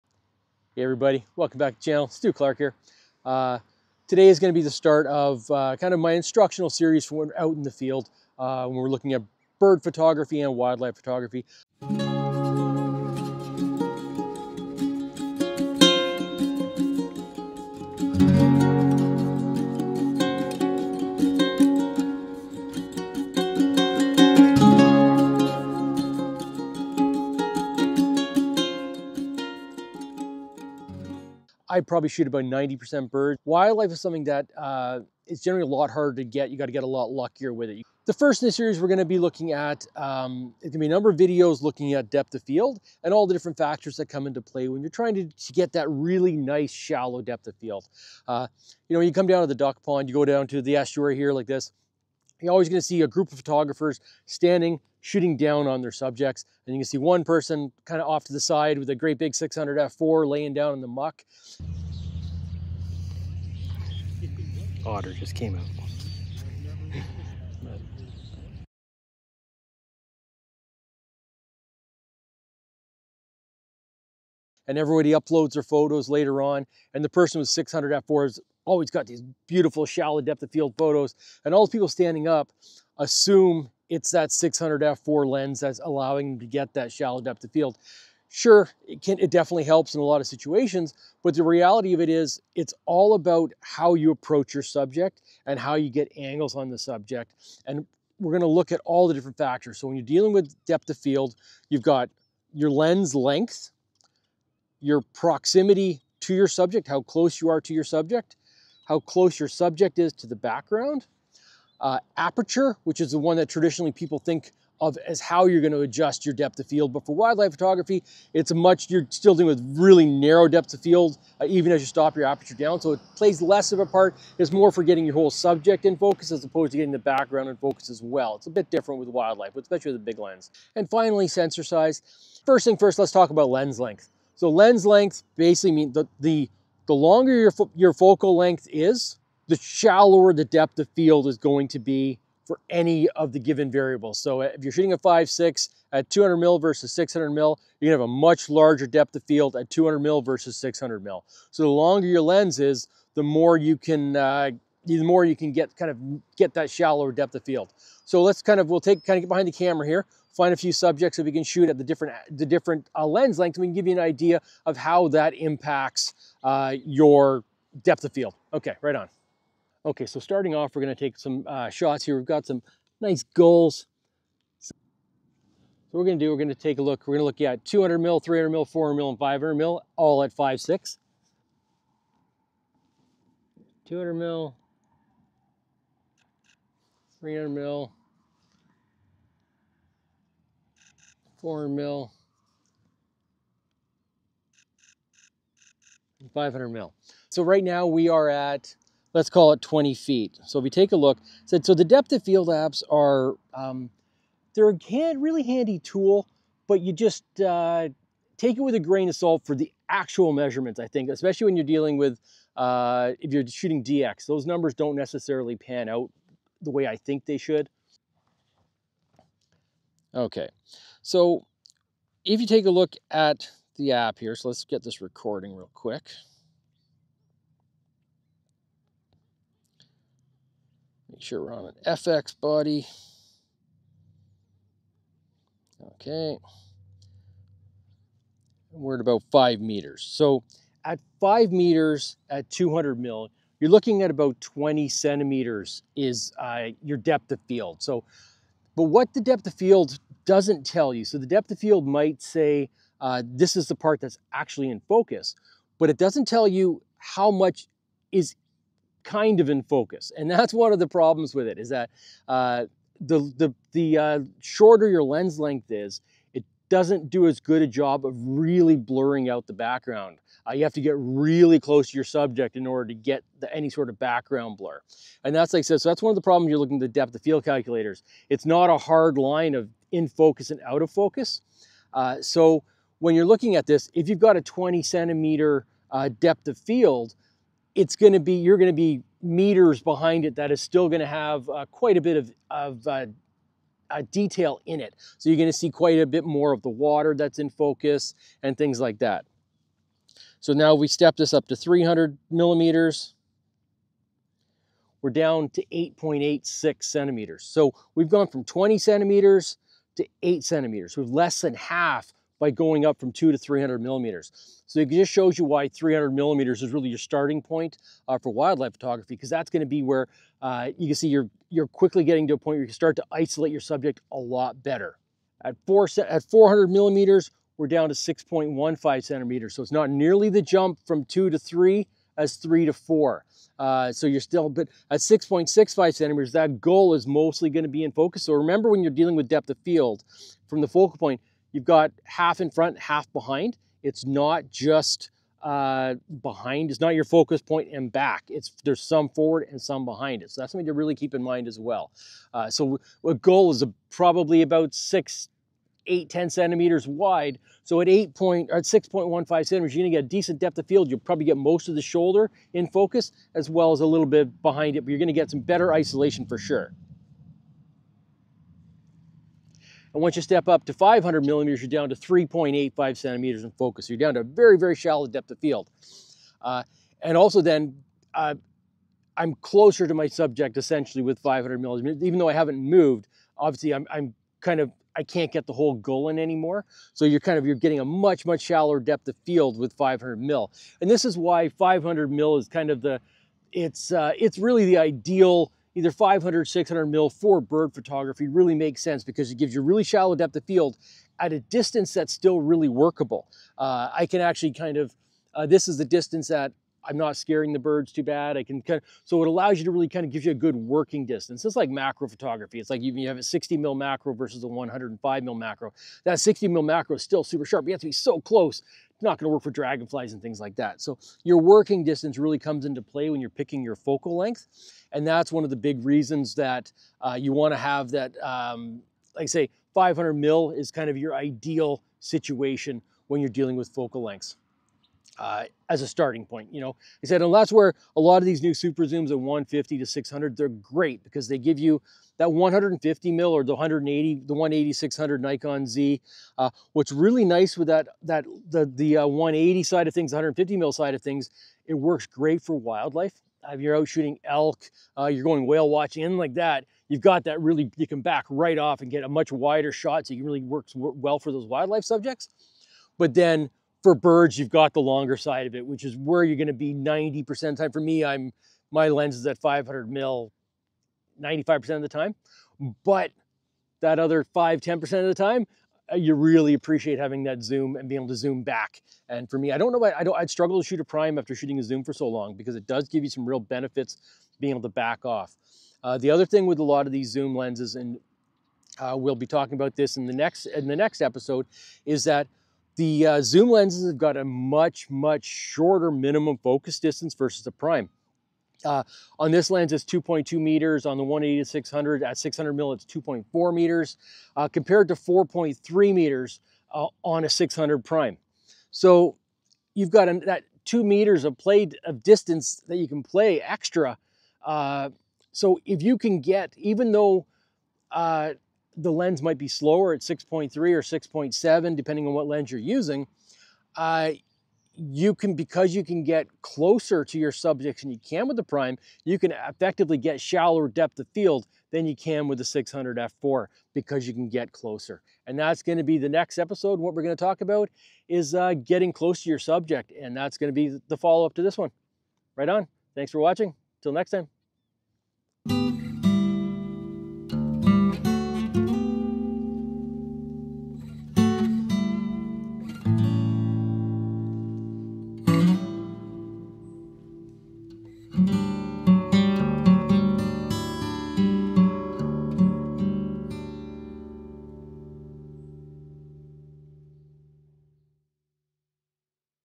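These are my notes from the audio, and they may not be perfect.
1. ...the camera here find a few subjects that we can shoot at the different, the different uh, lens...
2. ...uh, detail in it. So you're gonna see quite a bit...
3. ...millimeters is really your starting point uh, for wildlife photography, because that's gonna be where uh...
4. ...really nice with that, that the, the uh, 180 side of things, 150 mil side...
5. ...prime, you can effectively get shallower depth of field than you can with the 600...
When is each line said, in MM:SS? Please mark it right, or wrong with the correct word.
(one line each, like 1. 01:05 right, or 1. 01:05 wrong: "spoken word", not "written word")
1. 02:39 right
2. 04:53 right
3. 05:16 right
4. 07:26 right
5. 08:48 right.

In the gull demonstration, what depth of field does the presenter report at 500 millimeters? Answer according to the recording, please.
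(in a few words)
3.85 centimeters.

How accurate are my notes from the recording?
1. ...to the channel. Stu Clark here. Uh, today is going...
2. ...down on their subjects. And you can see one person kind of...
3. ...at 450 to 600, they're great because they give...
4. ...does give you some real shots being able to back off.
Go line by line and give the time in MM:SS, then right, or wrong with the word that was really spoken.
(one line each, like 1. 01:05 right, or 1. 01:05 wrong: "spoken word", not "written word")
1. 00:01 right
2. 00:55 right
3. 07:19 wrong: "150", not "450"
4. 08:02 wrong: "benefits", not "shots".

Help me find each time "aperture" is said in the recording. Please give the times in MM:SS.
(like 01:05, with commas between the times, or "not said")
01:52, 02:02.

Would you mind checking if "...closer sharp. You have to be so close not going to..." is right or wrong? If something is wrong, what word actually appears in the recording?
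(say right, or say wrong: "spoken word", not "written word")
wrong: "super", not "closer".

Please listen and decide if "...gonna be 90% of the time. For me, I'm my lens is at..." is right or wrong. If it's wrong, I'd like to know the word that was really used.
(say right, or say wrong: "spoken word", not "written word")
right.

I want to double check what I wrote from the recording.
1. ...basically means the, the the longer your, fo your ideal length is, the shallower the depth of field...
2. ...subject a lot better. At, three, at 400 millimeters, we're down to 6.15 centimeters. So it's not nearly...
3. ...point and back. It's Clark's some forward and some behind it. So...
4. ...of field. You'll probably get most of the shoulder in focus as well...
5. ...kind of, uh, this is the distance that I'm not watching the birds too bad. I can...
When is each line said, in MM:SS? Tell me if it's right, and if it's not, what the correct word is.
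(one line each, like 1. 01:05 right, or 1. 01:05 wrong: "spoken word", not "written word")
1. 02:15 wrong: "focal", not "ideal"
2. 05:23 wrong: "four", not "three"
3. 05:47 wrong: "There", not "Clark"
4. 06:00 right
5. 06:44 wrong: "scaring", not "watching".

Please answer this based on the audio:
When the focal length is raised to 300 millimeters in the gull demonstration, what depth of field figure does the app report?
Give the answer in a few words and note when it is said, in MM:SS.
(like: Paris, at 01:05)
8.86 centimeters, at 05:05.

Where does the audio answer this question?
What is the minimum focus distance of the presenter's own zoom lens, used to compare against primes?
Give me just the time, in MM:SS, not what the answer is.
08:19.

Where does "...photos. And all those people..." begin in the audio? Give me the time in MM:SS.
01:20.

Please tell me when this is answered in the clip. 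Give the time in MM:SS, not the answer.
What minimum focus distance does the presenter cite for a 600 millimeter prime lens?
08:24.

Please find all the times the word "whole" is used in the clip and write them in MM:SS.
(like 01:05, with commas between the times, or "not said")
02:05, 06:25.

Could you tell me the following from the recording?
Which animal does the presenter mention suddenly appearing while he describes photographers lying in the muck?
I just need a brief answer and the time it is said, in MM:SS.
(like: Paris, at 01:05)
Otter, at 01:04.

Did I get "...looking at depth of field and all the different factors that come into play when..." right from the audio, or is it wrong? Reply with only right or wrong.
right.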